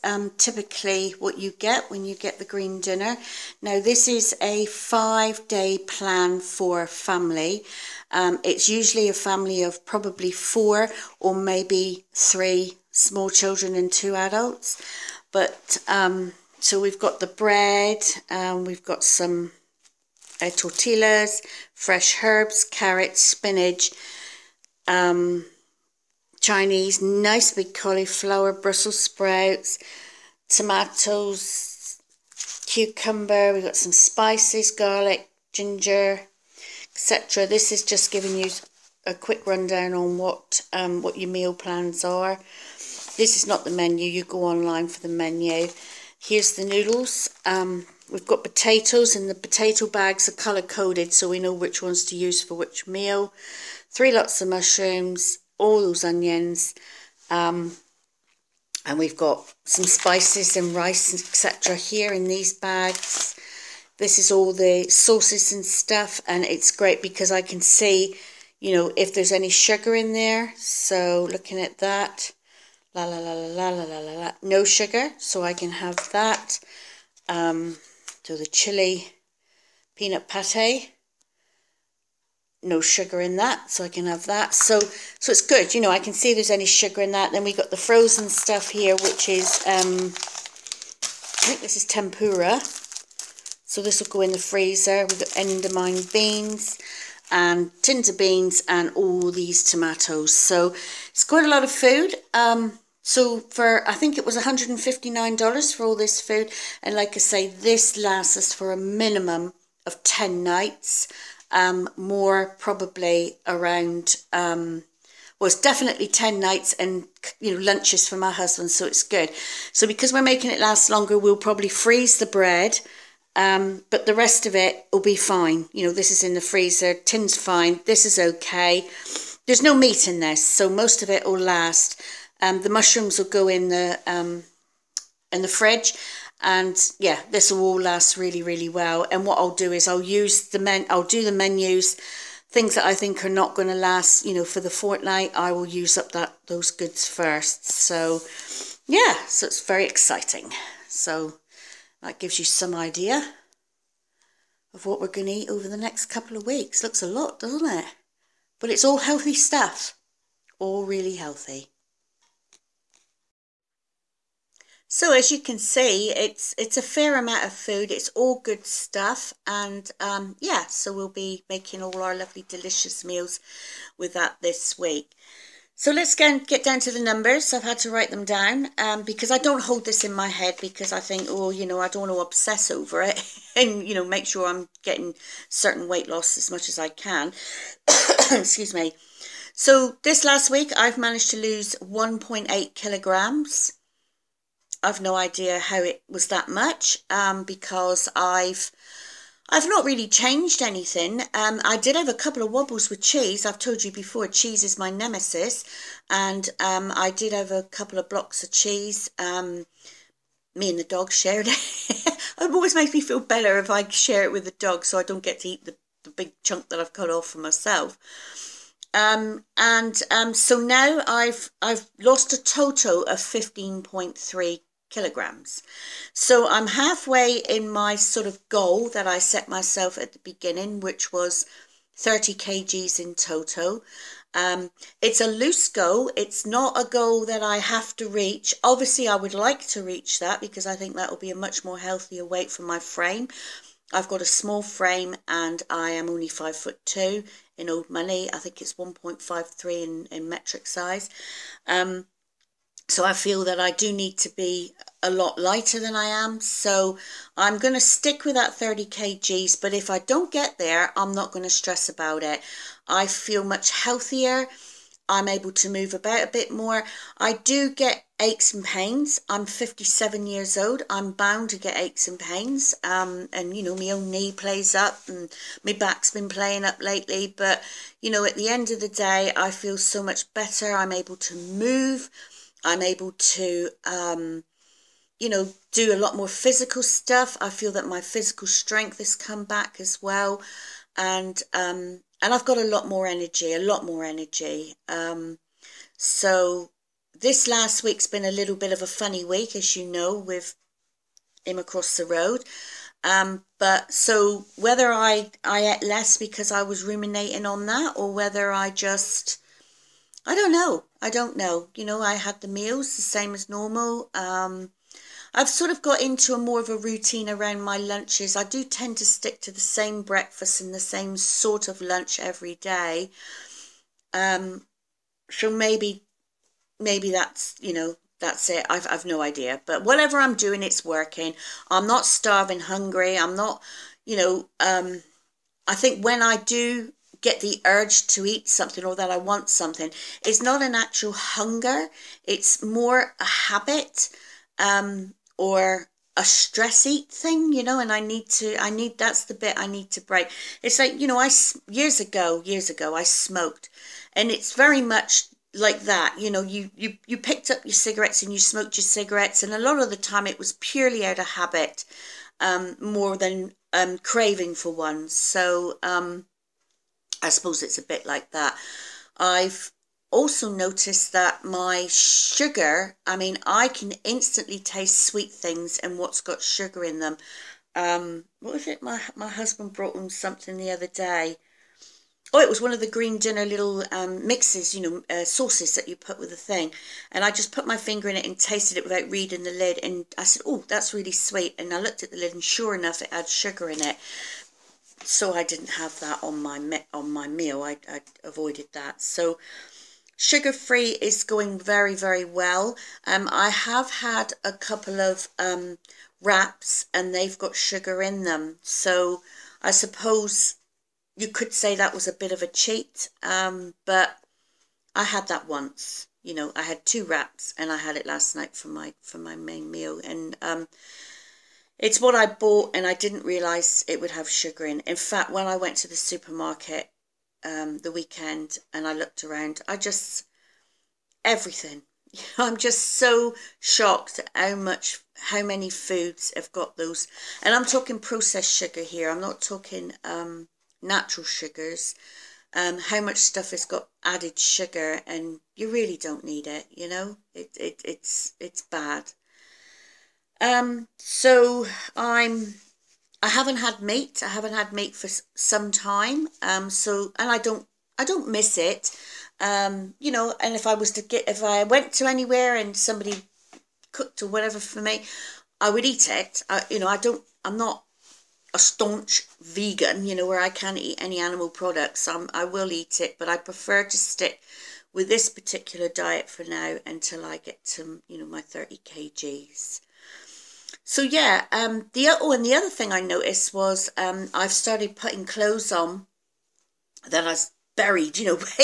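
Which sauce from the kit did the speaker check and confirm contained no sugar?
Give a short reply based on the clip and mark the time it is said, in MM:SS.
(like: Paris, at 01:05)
Chili peanut pate, at 01:18.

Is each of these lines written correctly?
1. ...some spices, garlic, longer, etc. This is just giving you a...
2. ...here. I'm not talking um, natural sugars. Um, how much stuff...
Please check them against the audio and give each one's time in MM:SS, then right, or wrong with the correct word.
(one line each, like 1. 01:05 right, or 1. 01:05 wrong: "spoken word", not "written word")
1. 00:33 wrong: "ginger", not "longer"
2. 07:18 right.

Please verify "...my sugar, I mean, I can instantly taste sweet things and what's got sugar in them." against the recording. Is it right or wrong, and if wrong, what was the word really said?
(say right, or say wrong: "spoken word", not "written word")
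right.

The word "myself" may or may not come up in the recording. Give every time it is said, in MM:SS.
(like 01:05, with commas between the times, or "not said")
03:37, 03:49.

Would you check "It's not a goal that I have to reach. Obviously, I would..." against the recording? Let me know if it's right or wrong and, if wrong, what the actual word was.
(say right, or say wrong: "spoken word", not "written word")
right.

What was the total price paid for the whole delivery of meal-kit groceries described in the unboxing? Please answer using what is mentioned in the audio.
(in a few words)
$159.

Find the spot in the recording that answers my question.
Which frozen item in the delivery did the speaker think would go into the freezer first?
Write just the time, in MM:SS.
01:31.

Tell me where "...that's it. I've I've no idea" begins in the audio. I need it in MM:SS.
05:28.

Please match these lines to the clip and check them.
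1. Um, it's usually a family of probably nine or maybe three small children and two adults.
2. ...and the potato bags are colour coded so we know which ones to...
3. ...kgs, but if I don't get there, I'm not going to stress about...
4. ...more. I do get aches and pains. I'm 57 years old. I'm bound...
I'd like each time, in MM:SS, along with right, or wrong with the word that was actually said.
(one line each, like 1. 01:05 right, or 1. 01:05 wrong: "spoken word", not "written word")
1. 00:08 wrong: "four", not "nine"
2. 00:49 right
3. 04:18 right
4. 04:26 right.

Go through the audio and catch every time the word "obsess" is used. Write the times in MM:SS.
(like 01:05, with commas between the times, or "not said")
03:02.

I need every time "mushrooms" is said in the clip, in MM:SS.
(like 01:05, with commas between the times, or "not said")
00:54, 02:12.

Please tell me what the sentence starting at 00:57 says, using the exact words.
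Um, and we've got some spices and rice, etc.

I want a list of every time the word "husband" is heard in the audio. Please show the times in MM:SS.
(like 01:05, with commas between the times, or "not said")
01:58, 06:19.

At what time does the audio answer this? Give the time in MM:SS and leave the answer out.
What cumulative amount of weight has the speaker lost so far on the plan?
03:43.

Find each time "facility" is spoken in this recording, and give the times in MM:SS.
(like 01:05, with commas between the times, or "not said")
not said.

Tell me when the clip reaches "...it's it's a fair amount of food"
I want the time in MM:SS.
02:46.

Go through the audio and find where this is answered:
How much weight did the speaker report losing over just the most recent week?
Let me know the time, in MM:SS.
03:11.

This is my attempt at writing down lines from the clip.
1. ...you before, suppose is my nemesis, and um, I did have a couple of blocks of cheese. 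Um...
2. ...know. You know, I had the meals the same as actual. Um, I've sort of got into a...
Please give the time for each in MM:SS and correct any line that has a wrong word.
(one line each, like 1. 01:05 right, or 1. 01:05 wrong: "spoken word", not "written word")
1. 03:23 wrong: "cheese", not "suppose"
2. 05:11 wrong: "normal", not "actual".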